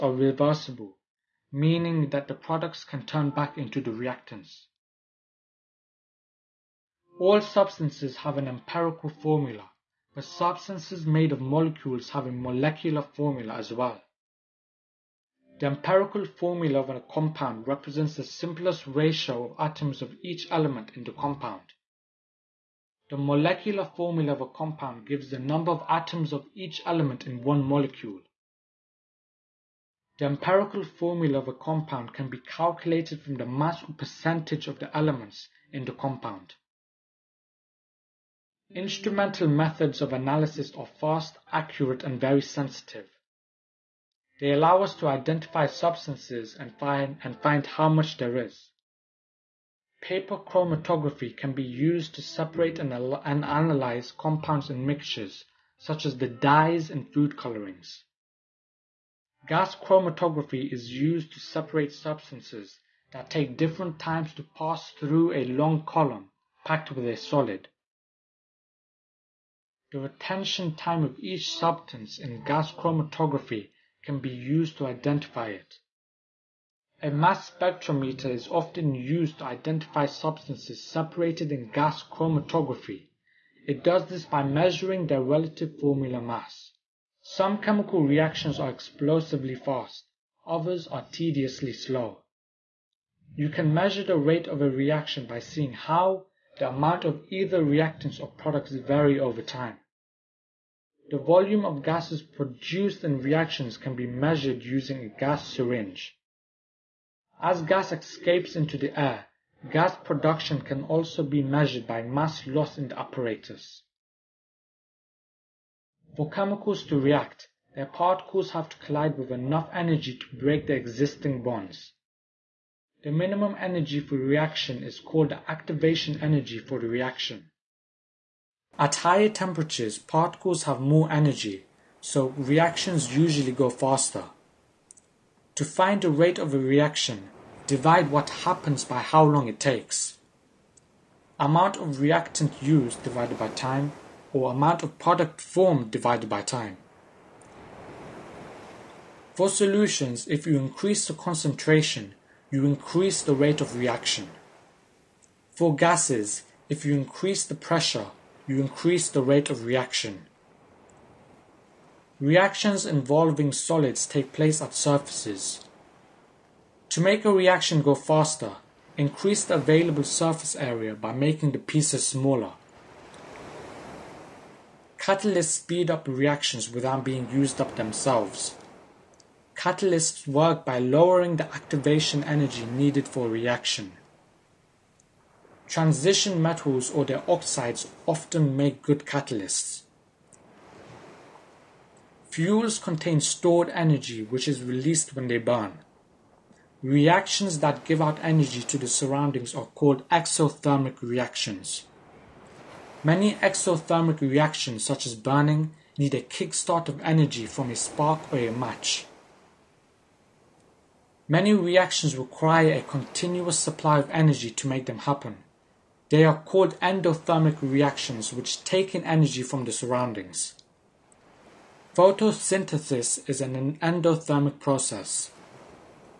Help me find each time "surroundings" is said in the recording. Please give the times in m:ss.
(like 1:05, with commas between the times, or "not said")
3:18, 3:39.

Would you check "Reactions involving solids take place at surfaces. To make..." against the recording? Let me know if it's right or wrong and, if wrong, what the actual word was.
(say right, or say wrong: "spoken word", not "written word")
right.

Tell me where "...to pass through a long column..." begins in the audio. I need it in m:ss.
1:04.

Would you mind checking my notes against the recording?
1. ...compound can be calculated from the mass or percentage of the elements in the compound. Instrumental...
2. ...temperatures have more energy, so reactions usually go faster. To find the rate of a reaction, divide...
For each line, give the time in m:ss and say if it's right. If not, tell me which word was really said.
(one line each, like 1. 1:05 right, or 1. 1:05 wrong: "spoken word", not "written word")
1. 0:31 right
2. 2:09 wrong: "particles", not "temperatures".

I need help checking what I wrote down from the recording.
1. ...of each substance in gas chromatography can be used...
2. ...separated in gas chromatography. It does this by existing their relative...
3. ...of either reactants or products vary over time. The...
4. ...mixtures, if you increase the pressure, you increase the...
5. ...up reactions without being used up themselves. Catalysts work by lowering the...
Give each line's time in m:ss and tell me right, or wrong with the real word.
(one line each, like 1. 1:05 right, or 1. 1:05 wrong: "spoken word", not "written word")
1. 1:11 right
2. 1:20 wrong: "measuring", not "existing"
3. 1:37 right
4. 2:35 wrong: "gases", not "mixtures"
5. 2:55 right.